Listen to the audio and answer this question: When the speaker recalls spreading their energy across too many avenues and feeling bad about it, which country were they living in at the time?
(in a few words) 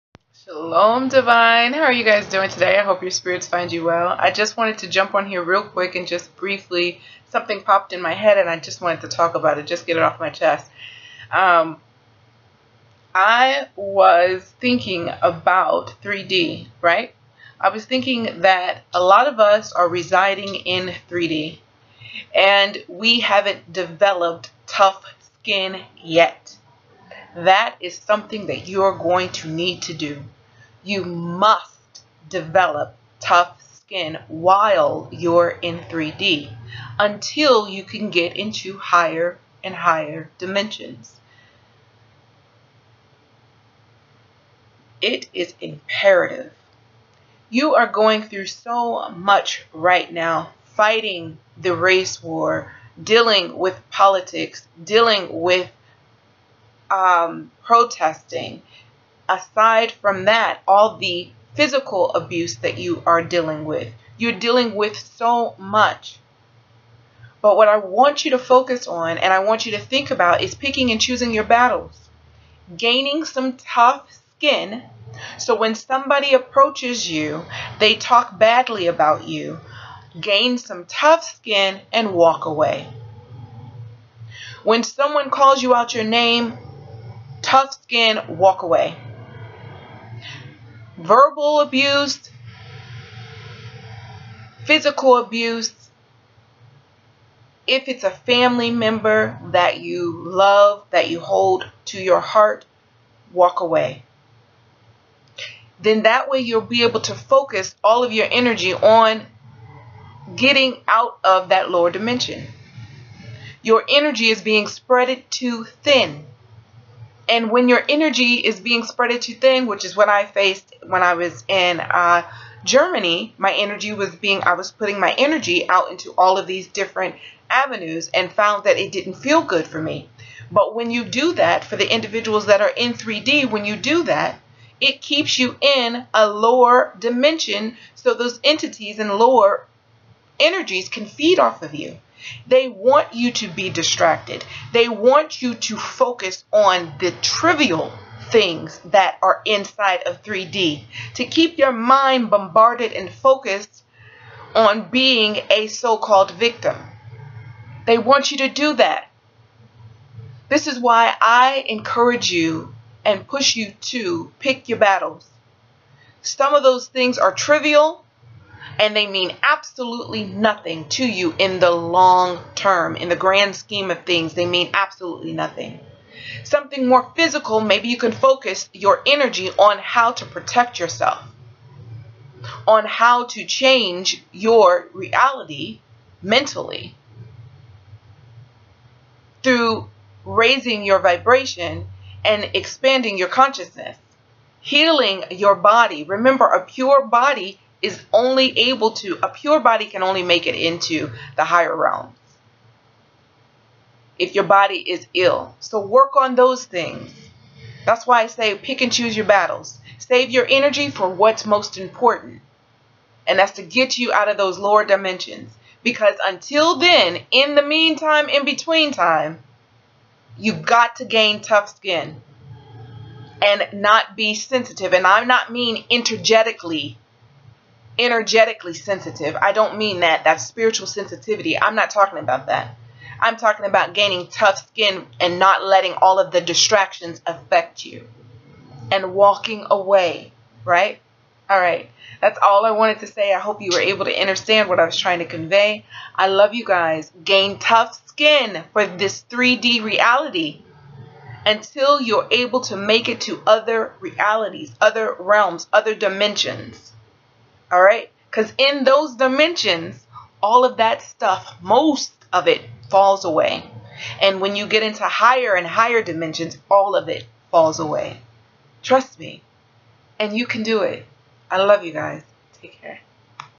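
Germany.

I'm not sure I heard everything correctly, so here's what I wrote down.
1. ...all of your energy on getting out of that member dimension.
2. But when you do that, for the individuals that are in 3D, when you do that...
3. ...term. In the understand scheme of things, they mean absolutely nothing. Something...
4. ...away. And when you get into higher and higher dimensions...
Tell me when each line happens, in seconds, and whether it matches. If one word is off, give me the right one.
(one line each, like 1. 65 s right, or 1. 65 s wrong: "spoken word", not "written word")
1. 107 s wrong: "lower", not "member"
2. 130 s right
3. 172 s wrong: "grand", not "understand"
4. 263 s right.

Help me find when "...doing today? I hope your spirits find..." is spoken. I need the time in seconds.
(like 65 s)
2 s.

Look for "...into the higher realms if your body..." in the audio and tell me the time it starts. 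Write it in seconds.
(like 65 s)
200 s.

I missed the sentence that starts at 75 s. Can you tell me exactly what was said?
So when somebody approaches you, they talk badly about you, gain some tough skin and walk away.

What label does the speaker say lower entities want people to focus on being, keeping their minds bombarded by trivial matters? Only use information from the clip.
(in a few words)
Victim.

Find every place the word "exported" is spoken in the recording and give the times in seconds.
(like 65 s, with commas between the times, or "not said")
not said.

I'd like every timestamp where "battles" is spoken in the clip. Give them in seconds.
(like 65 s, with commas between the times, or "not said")
71 s, 164 s, 209 s.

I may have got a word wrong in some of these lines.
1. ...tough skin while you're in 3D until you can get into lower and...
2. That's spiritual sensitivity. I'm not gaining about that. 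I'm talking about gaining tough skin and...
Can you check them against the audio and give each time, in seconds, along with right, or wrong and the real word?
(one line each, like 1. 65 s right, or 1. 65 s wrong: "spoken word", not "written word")
1. 33 s wrong: "higher", not "lower"
2. 230 s wrong: "talking", not "gaining".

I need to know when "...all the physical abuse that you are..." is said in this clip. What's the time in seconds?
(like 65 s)
60 s.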